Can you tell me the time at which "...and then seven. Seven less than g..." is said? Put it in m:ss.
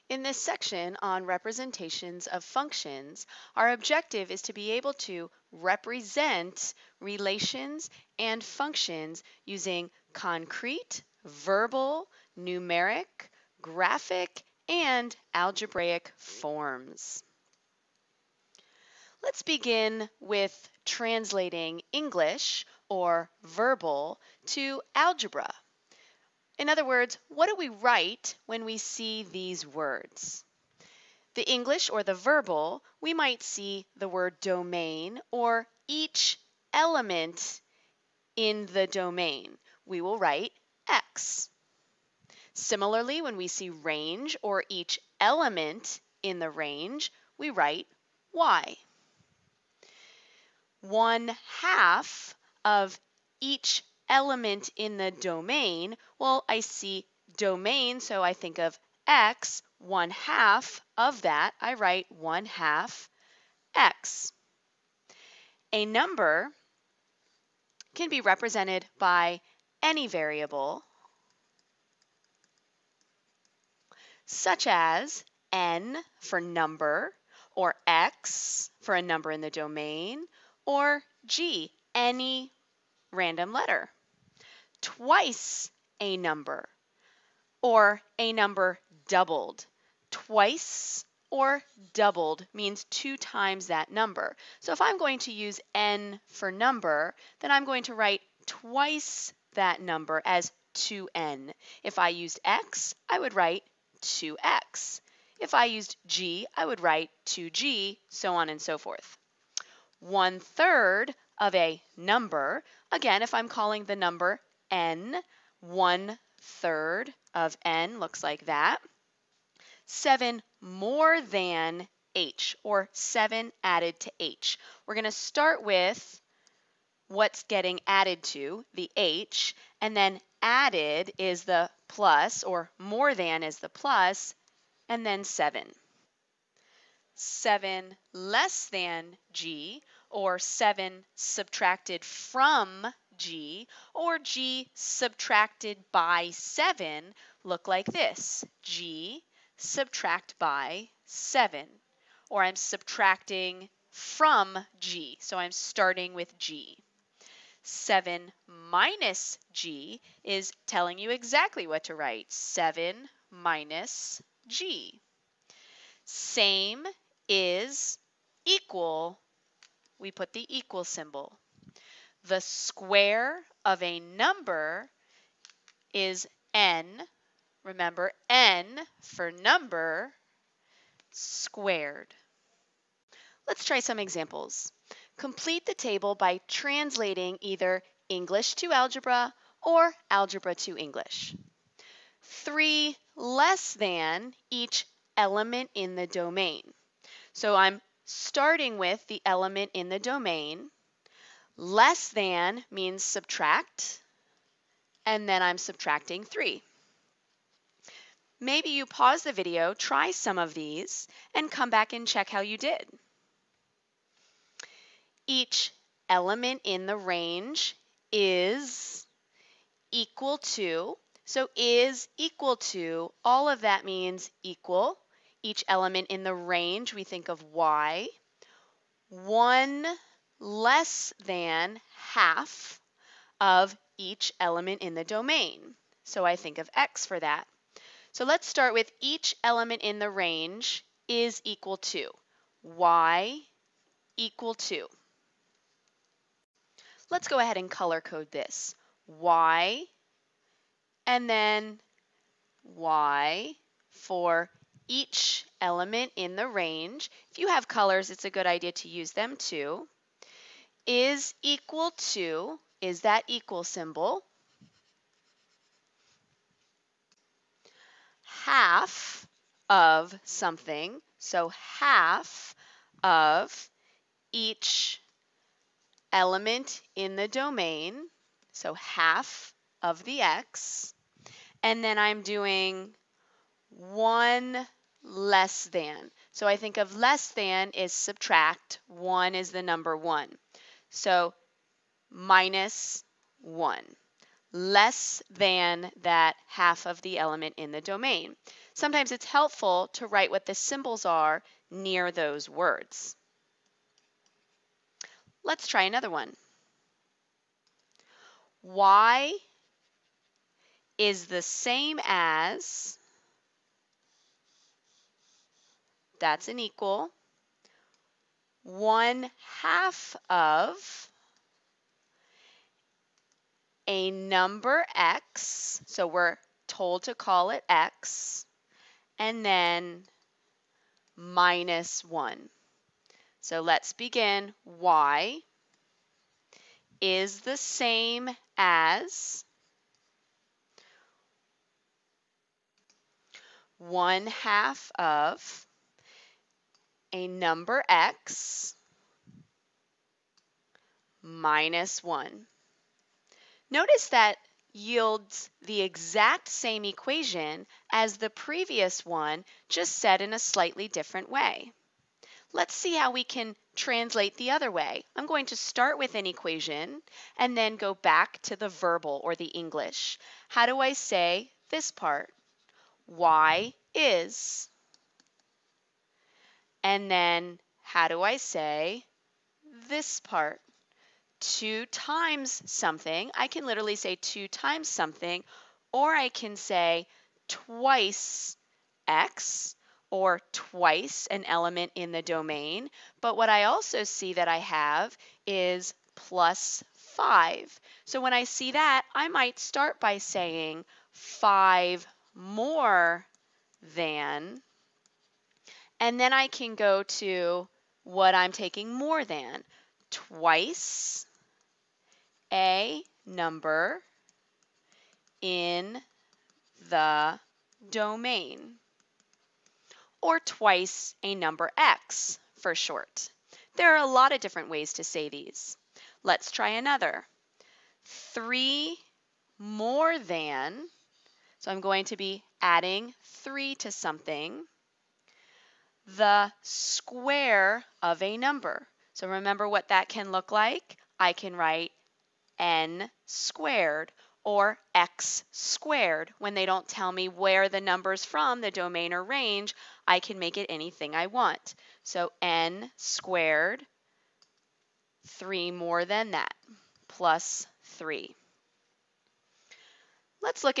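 2:14.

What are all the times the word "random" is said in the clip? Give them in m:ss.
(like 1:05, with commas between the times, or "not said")
1:23.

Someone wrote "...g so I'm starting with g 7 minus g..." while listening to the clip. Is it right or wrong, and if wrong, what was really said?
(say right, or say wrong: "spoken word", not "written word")
right.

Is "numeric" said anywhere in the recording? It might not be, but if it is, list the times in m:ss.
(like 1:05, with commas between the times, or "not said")
0:12.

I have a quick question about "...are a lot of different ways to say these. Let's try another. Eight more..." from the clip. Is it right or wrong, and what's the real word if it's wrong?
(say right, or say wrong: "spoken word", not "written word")
wrong: "Three", not "Eight".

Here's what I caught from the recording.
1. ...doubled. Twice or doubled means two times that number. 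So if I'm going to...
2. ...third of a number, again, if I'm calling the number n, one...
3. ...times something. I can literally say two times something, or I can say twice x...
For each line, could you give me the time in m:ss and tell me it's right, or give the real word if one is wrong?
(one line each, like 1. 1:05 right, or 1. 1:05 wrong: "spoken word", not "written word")
1. 1:29 right
2. 1:50 right
3. 6:21 right.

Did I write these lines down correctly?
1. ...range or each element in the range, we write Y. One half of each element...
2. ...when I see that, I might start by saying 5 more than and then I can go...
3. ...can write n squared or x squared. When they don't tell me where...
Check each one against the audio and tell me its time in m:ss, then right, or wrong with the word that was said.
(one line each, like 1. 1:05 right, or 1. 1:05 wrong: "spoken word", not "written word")
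1. 0:43 right
2. 6:38 right
3. 7:21 right.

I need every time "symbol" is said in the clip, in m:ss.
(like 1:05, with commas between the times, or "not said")
2:50, 4:23, 5:00.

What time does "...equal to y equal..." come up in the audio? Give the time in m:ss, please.
4:01.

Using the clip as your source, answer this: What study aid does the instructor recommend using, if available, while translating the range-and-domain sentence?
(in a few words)
colors.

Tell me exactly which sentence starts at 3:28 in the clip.
Maybe you pause the video, try some of these, and come back and check how you did.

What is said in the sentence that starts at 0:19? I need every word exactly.
Let's begin with translating English or verbal to algebra in other words, what do we write when we see these words?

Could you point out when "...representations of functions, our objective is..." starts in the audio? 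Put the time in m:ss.
0:01.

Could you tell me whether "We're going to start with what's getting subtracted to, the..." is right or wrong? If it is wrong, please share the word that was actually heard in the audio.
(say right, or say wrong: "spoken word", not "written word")
wrong: "added", not "subtracted".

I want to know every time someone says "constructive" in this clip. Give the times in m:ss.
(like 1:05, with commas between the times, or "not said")
not said.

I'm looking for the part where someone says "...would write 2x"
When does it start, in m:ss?
1:43.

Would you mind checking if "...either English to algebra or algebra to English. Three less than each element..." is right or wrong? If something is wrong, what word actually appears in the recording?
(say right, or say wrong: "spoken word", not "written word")
right.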